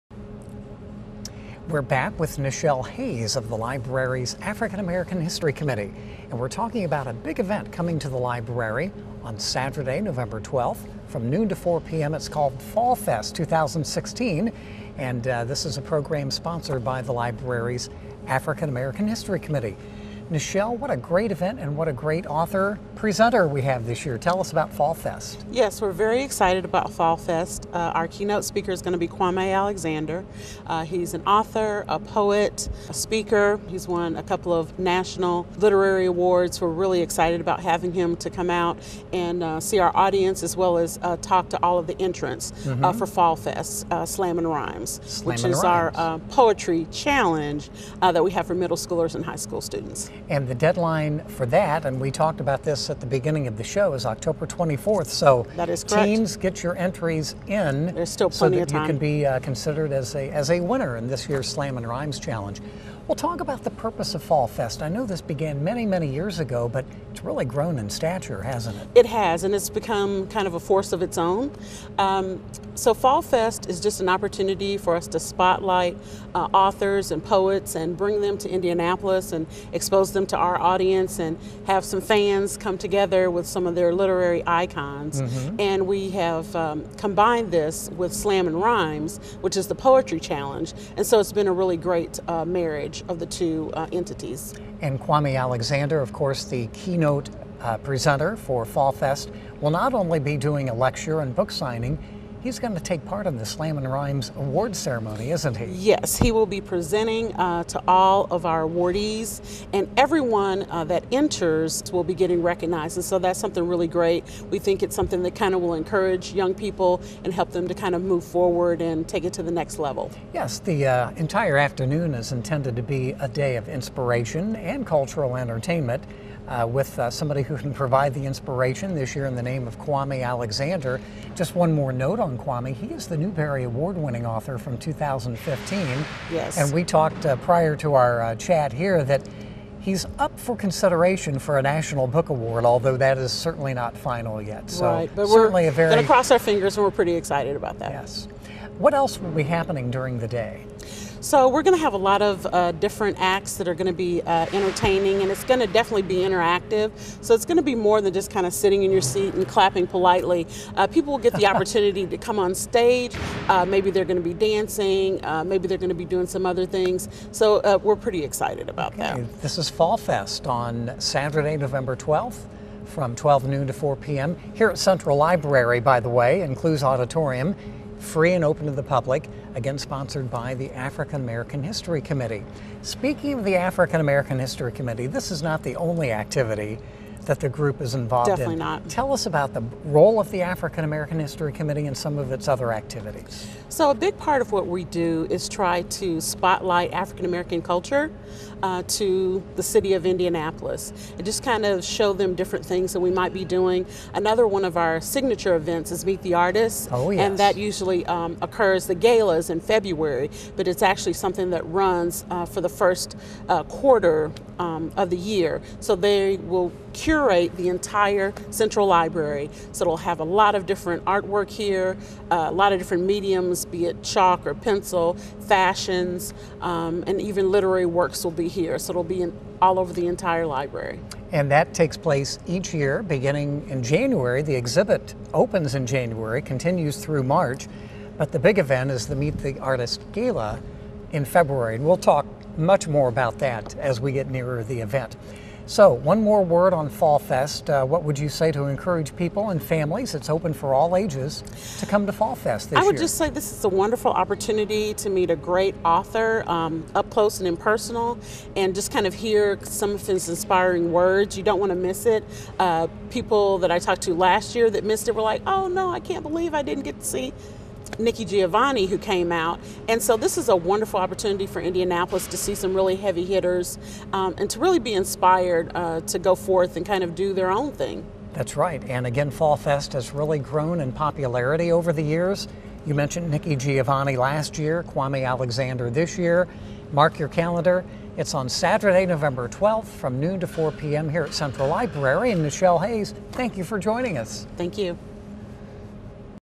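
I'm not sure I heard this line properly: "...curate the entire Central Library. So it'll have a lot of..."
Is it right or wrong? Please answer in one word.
right.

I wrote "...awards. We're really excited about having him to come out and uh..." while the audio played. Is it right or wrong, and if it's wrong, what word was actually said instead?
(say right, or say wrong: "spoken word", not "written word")
right.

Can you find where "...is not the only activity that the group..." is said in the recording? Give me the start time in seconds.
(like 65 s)
185 s.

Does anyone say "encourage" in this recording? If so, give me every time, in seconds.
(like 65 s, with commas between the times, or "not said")
115 s, 248 s.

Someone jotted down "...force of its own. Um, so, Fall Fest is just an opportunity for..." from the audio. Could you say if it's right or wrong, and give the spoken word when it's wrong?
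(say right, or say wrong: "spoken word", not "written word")
right.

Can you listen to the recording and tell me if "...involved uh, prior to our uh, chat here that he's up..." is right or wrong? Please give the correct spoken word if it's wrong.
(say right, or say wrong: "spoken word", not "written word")
wrong: "talked", not "involved".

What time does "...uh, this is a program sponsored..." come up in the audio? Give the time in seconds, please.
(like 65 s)
15 s.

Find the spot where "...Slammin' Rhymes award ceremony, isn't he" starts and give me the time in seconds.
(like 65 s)
103 s.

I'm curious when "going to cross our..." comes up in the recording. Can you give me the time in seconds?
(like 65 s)
145 s.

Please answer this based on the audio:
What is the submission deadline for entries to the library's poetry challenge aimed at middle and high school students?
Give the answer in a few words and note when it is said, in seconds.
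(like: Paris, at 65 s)
October 24th, at 54 s.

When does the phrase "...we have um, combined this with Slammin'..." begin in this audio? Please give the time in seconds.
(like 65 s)
85 s.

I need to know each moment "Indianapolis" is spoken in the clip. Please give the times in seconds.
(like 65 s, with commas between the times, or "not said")
78 s, 200 s, 271 s.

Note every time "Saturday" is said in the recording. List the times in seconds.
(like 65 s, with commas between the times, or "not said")
9 s, 170 s, 288 s.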